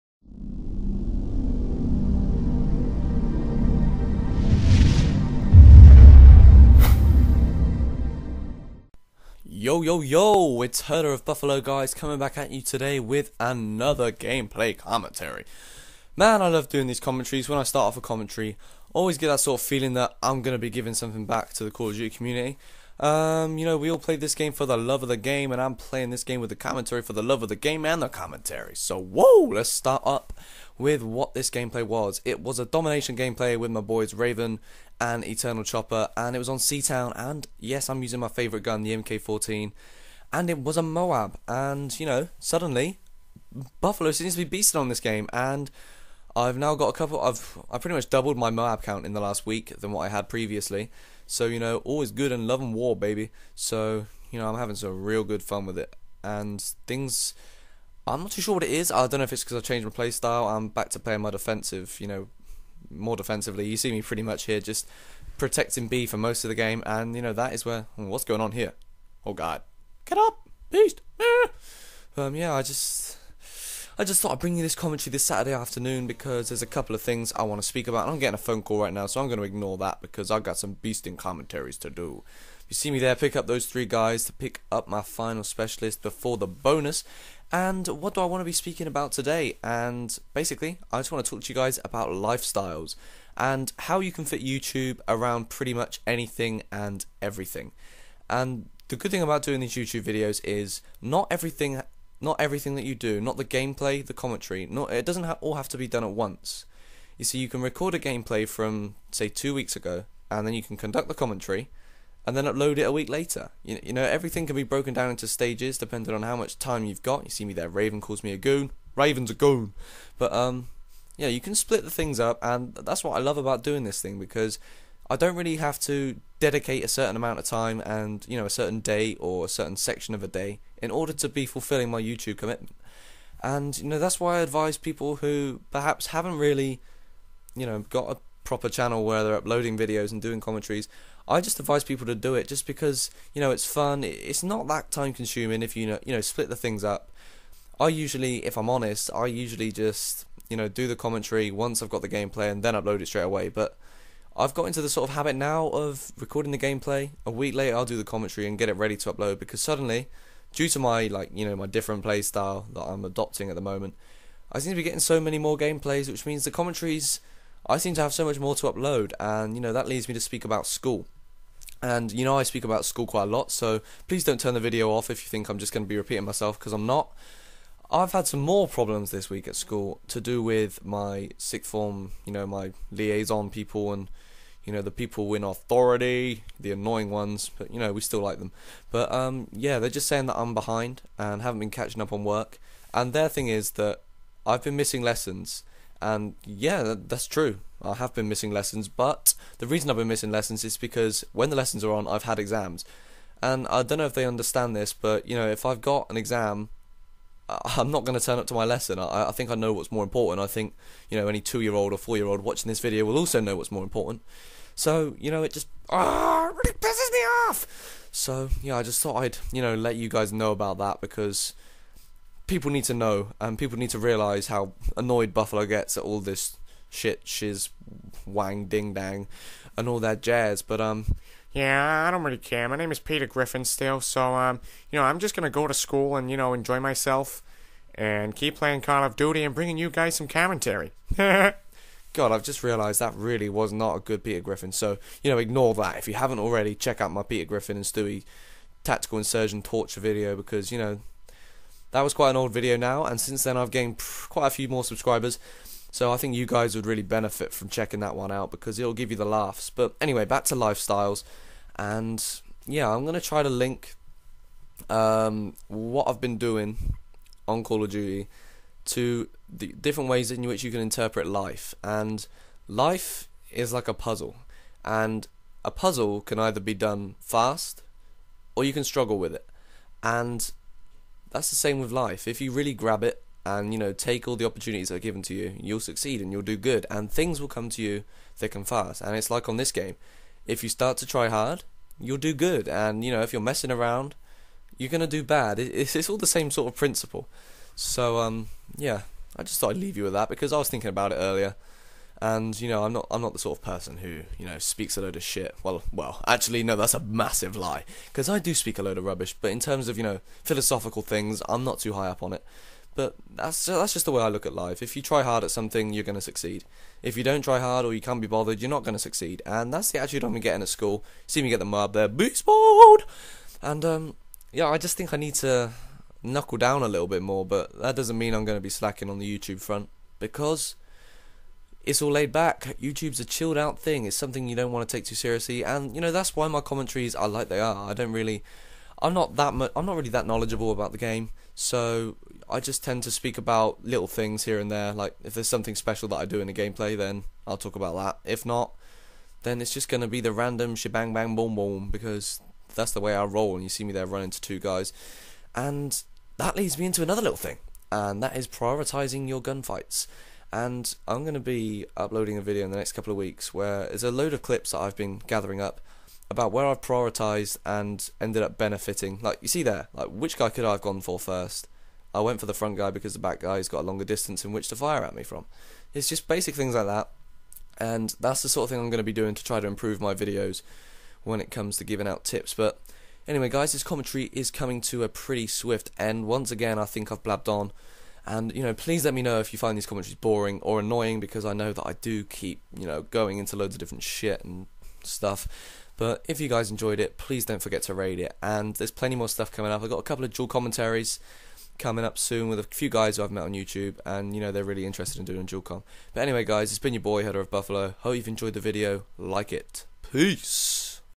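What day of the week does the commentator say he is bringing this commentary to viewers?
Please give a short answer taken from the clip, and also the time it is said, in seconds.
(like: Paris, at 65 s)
Saturday, at 75 s.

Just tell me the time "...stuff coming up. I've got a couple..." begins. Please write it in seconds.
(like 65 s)
399 s.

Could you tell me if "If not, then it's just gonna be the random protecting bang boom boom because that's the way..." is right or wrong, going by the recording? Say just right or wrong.
wrong.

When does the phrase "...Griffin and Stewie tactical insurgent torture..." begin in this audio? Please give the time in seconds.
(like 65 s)
247 s.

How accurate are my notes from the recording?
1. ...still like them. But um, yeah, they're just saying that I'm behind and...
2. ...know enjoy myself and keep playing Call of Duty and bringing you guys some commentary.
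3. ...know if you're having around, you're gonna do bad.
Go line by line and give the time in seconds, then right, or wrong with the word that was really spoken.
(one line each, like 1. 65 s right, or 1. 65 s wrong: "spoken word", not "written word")
1. 188 s right
2. 236 s right
3. 293 s wrong: "messing", not "having".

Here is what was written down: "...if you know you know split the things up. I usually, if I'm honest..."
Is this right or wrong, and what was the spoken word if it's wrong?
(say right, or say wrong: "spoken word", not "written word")
right.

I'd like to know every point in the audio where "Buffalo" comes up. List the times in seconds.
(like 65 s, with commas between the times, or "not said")
11 s, 43 s, 225 s, 407 s.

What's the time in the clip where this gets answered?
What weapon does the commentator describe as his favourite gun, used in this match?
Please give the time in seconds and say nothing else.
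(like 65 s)
38 s.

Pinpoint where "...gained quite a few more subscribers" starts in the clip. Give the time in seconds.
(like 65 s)
253 s.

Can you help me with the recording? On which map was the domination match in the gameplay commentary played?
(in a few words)
Seatown.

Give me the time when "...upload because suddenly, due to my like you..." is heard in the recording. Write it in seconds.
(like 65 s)
159 s.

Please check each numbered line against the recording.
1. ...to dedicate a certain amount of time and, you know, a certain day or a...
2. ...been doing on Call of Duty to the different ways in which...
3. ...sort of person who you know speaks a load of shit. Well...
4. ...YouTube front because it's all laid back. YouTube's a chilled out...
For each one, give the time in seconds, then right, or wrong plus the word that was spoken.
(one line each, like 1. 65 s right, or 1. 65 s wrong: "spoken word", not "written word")
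1. 125 s right
2. 266 s right
3. 303 s right
4. 329 s right.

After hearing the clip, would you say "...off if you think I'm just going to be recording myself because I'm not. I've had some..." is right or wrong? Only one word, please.
wrong.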